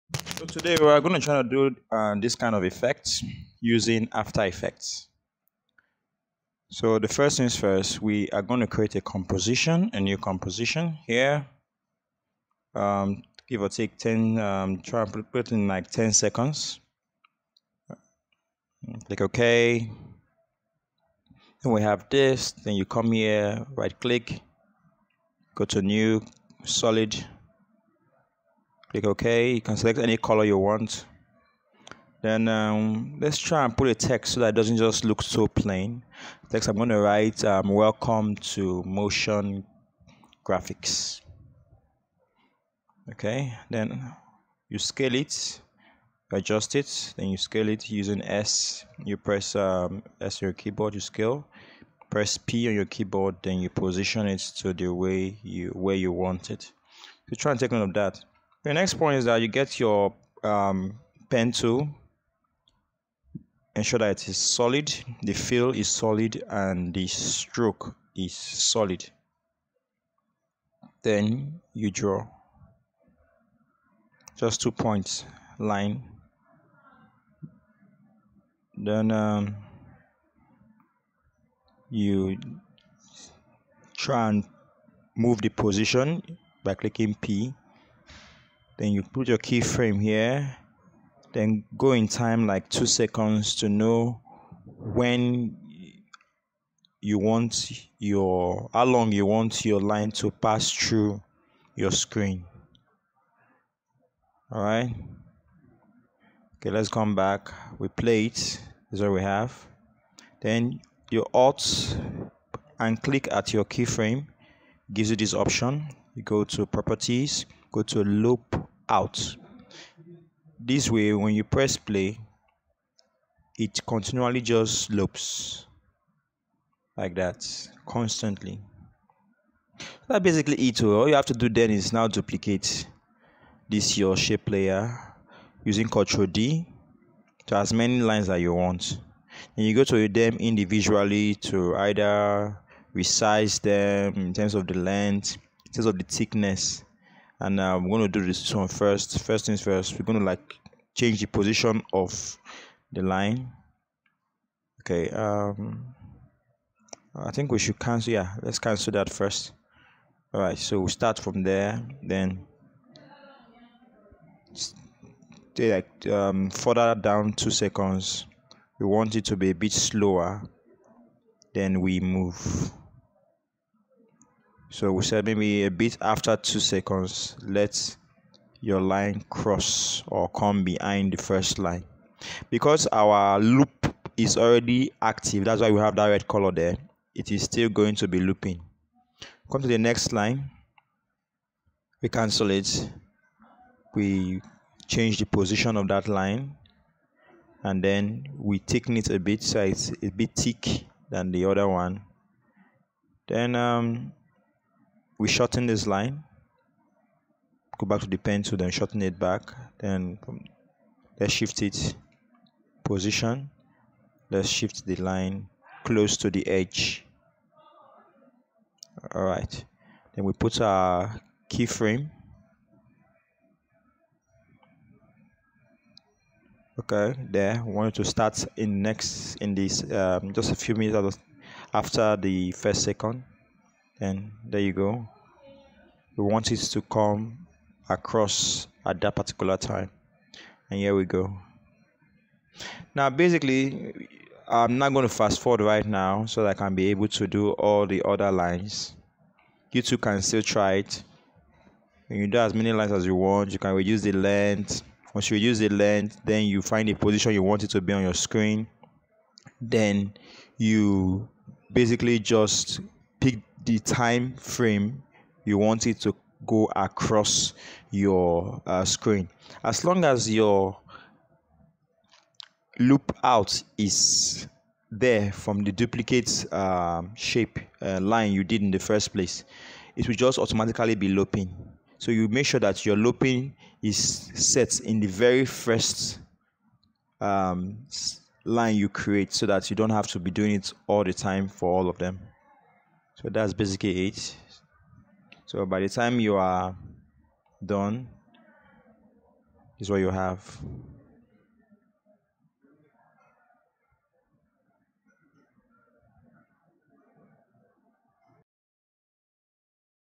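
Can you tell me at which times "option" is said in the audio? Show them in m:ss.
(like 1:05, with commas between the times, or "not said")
1:55.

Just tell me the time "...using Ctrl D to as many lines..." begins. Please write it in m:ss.
2:15.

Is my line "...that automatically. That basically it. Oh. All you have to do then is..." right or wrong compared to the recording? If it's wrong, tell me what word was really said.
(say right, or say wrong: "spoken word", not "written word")
wrong: "constantly", not "automatically".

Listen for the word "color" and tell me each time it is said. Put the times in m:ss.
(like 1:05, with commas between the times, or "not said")
0:30, 3:06.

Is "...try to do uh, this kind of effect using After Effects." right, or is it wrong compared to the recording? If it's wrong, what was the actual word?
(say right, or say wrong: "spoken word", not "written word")
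right.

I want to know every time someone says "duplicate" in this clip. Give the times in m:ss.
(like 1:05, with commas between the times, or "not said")
2:12, 4:35.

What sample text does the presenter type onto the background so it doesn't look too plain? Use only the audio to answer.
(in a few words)
Welcome to motion graphics.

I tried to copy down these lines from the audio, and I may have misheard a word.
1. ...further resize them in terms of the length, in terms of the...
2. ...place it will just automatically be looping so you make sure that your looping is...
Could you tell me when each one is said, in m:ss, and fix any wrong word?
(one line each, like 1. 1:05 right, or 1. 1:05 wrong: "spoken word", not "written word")
1. 2:21 wrong: "either", not "further"
2. 4:39 right.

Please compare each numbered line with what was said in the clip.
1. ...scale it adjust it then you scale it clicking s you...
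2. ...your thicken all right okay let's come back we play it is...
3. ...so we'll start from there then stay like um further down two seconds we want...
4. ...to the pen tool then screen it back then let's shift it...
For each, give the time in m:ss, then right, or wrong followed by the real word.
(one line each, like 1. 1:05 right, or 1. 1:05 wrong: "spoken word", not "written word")
1. 0:44 wrong: "using", not "clicking"
2. 1:41 wrong: "screen", not "thicken"
3. 2:40 right
4. 3:28 wrong: "shorten", not "screen".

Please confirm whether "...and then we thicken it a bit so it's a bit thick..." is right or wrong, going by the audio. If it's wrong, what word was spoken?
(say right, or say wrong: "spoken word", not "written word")
right.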